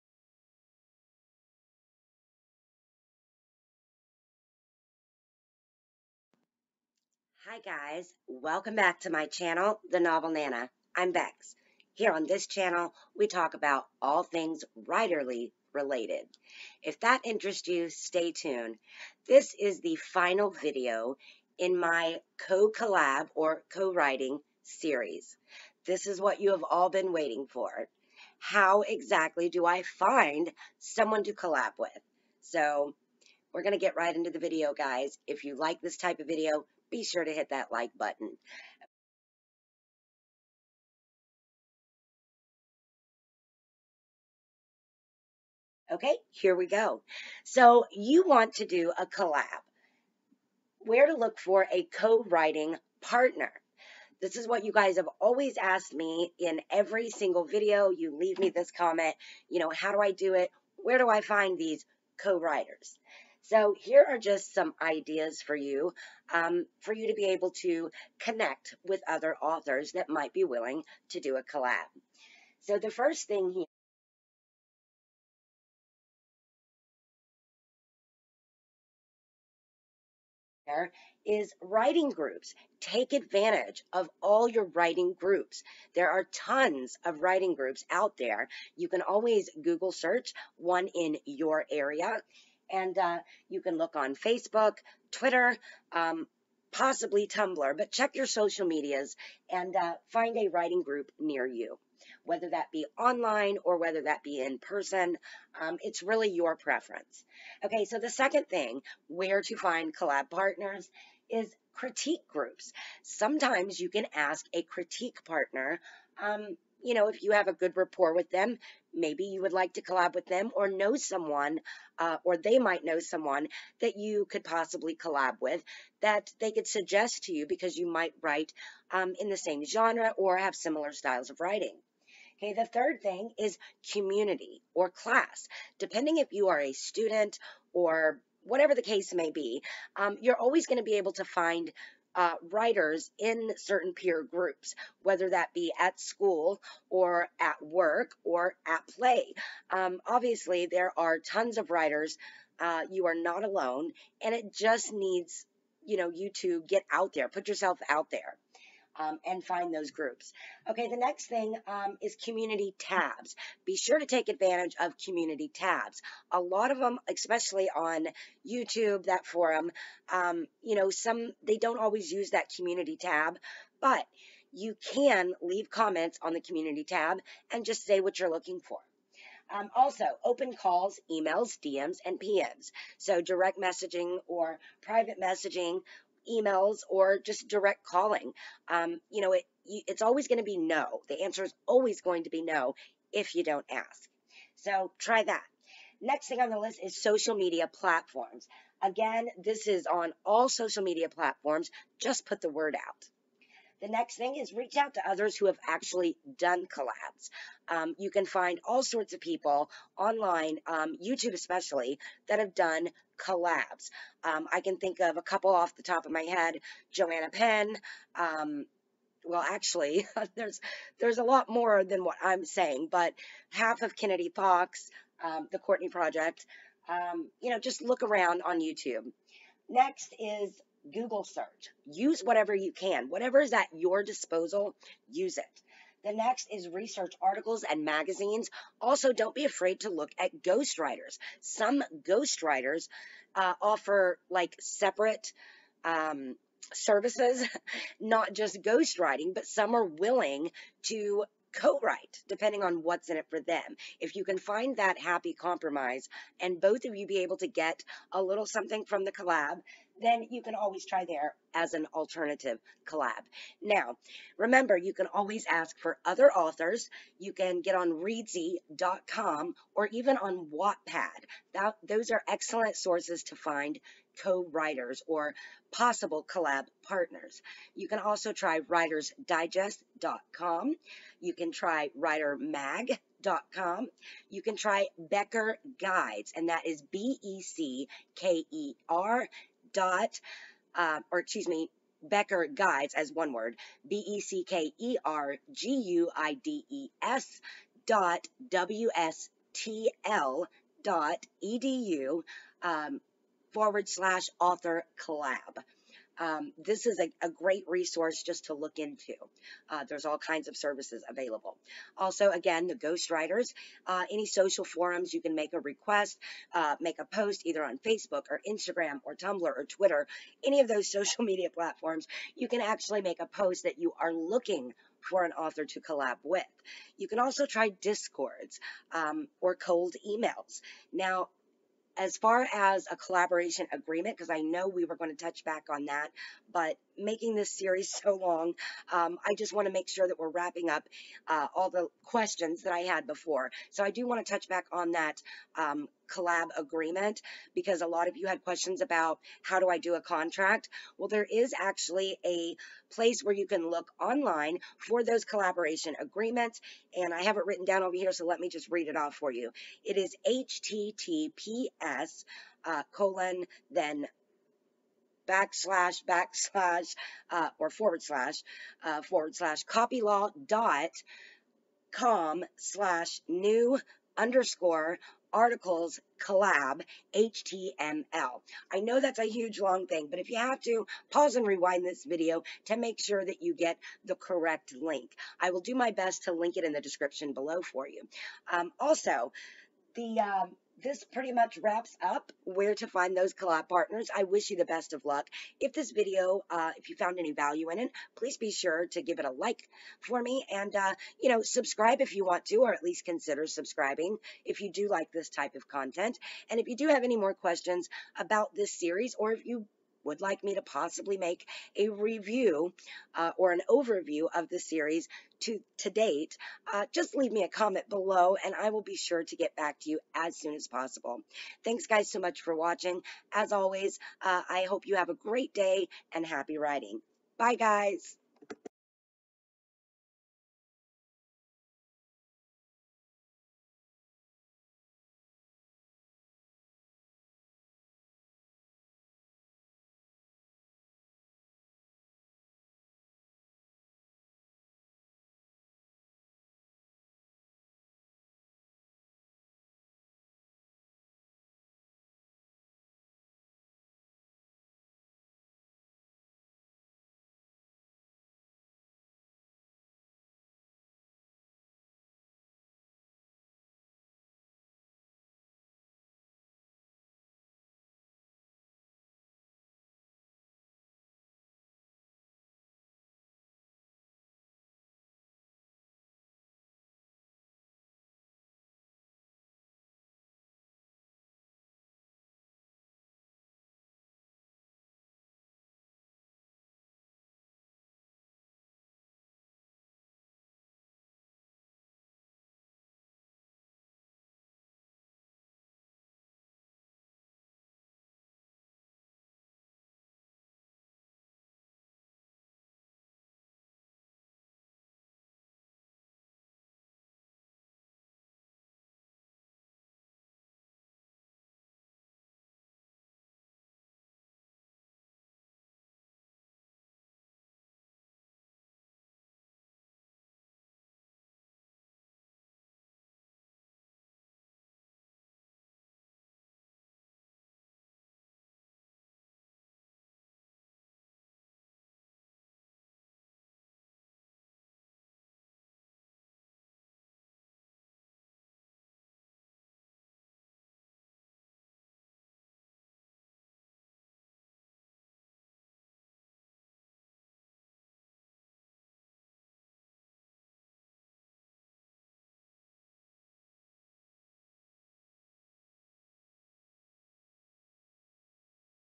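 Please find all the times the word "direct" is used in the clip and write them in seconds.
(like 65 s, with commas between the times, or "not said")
183 s, 187 s.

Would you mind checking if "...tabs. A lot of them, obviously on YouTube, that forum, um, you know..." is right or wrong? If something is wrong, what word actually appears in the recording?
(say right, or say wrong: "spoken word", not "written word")
wrong: "especially", not "obviously".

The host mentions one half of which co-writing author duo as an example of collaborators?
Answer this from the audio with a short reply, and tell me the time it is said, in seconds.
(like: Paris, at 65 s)
Kennedy Fox, at 223 s.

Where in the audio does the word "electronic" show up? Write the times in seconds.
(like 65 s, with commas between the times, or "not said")
not said.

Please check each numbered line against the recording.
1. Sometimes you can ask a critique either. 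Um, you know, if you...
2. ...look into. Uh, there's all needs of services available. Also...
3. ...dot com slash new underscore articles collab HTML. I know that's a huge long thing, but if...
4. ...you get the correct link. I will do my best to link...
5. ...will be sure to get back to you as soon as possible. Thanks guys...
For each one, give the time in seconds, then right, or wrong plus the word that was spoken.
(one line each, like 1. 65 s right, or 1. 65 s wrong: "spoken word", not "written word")
1. 113 s wrong: "partner", not "either"
2. 308 s wrong: "kinds", not "needs"
3. 370 s right
4. 383 s right
5. 418 s right.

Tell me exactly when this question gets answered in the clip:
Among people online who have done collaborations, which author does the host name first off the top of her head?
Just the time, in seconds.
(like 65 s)
216 s.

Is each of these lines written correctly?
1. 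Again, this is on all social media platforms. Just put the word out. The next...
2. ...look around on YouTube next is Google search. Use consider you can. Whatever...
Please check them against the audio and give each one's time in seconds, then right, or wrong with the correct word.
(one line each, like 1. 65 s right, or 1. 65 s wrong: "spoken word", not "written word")
1. 198 s right
2. 227 s wrong: "whatever", not "consider".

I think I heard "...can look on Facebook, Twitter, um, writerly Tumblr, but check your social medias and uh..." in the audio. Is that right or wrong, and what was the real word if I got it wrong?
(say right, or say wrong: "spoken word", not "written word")
wrong: "possibly", not "writerly".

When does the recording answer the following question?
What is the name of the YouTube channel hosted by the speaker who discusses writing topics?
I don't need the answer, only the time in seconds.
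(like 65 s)
9 s.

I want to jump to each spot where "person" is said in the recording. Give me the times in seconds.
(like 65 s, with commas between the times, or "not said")
104 s.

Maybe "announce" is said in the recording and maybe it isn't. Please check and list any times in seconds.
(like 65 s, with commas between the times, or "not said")
not said.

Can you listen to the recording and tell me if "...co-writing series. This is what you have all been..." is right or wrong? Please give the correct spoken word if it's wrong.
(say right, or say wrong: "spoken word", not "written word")
right.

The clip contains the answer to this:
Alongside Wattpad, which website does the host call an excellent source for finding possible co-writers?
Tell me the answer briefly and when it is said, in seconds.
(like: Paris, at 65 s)
Reedsy.com, at 267 s.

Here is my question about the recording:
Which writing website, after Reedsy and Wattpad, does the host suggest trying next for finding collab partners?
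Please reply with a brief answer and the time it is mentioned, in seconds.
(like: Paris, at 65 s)
writersdigest.com, at 278 s.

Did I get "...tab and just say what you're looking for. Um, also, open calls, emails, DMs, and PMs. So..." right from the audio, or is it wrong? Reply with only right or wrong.
right.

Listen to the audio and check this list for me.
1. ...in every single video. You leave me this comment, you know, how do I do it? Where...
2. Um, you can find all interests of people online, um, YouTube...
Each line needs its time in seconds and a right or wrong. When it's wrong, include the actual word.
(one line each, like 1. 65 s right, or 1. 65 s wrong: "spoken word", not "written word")
1. 56 s right
2. 207 s wrong: "sorts", not "interests".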